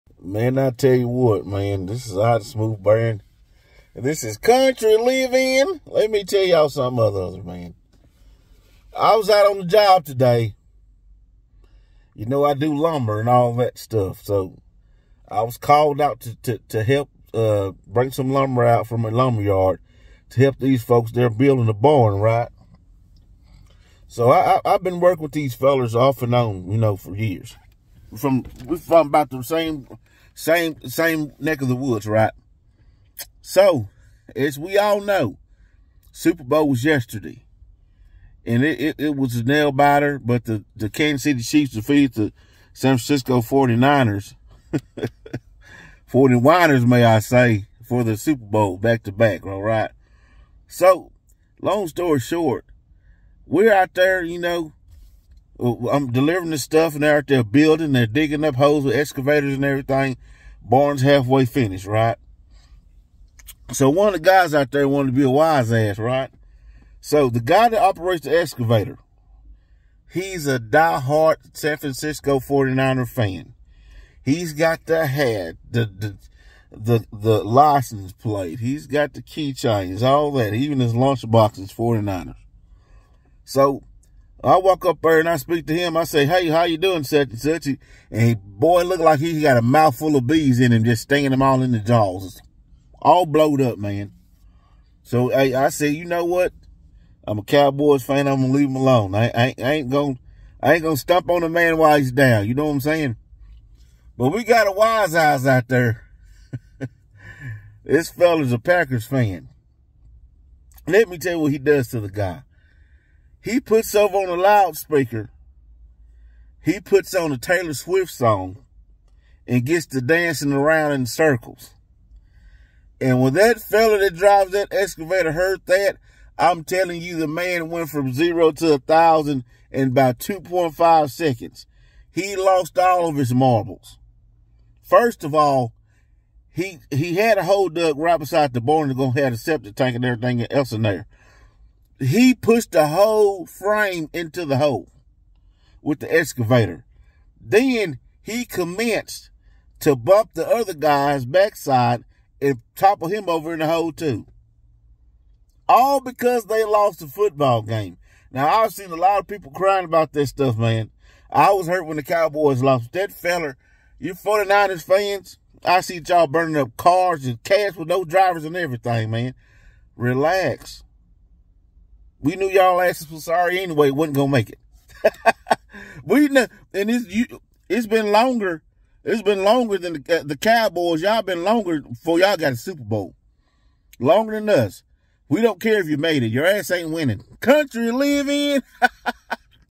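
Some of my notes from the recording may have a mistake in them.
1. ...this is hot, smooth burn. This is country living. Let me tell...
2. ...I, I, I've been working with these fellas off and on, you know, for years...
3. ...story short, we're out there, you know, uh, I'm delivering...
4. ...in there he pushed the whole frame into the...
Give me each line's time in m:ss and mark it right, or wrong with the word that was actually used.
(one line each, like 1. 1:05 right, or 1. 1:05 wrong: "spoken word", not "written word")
1. 0:01 right
2. 0:24 right
3. 0:51 right
4. 2:20 right.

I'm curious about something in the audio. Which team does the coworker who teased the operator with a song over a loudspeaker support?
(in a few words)
Packers.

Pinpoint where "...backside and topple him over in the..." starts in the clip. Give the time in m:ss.
2:31.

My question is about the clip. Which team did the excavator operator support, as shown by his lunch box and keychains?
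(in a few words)
San Francisco 49ers.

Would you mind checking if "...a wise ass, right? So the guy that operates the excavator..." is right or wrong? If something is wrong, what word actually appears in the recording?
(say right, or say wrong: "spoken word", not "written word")
right.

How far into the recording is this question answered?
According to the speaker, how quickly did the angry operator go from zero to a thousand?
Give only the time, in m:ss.
2:10.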